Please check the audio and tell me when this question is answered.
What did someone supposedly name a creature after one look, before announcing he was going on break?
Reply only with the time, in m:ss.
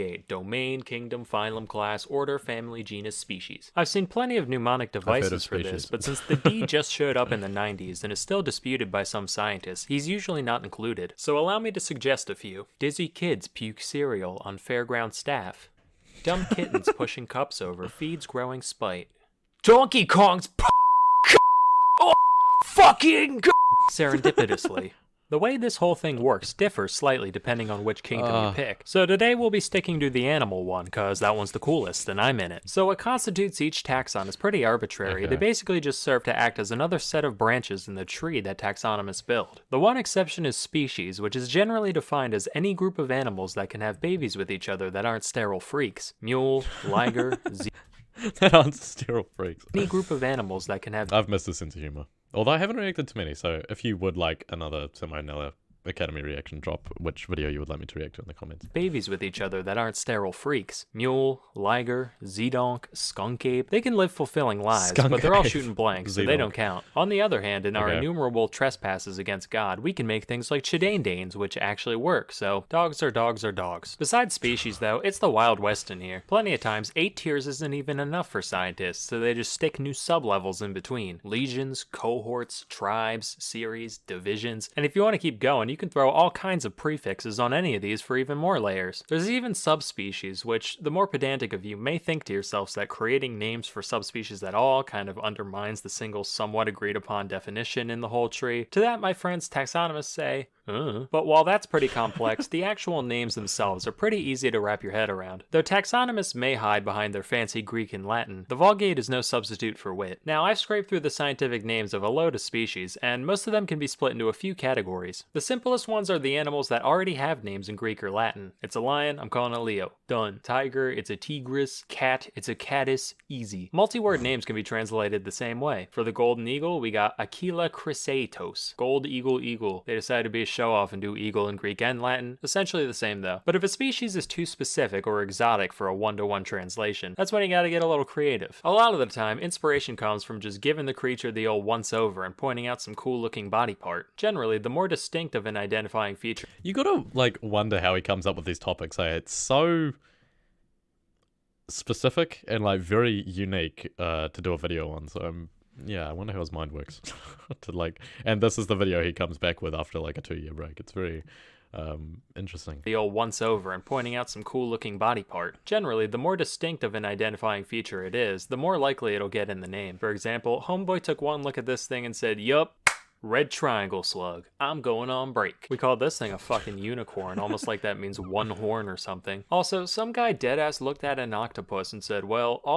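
2:53.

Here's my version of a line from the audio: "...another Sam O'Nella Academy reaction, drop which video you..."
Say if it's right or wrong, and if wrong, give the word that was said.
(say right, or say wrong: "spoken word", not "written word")
right.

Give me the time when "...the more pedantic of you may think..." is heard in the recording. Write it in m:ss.
1:30.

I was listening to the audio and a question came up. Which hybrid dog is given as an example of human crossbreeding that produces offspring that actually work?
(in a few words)
danes.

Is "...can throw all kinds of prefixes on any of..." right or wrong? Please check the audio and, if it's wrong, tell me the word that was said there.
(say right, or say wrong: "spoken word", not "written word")
right.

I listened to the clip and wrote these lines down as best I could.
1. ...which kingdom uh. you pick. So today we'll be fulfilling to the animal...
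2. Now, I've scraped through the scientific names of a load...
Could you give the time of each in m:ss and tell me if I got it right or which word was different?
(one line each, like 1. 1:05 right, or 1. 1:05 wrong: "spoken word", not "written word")
1. 0:27 wrong: "sticking", not "fulfilling"
2. 1:50 right.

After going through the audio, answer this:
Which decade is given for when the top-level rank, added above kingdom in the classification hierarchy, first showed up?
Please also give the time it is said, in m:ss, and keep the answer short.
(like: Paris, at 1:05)
the 90s, at 0:07.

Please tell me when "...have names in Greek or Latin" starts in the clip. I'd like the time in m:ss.
1:57.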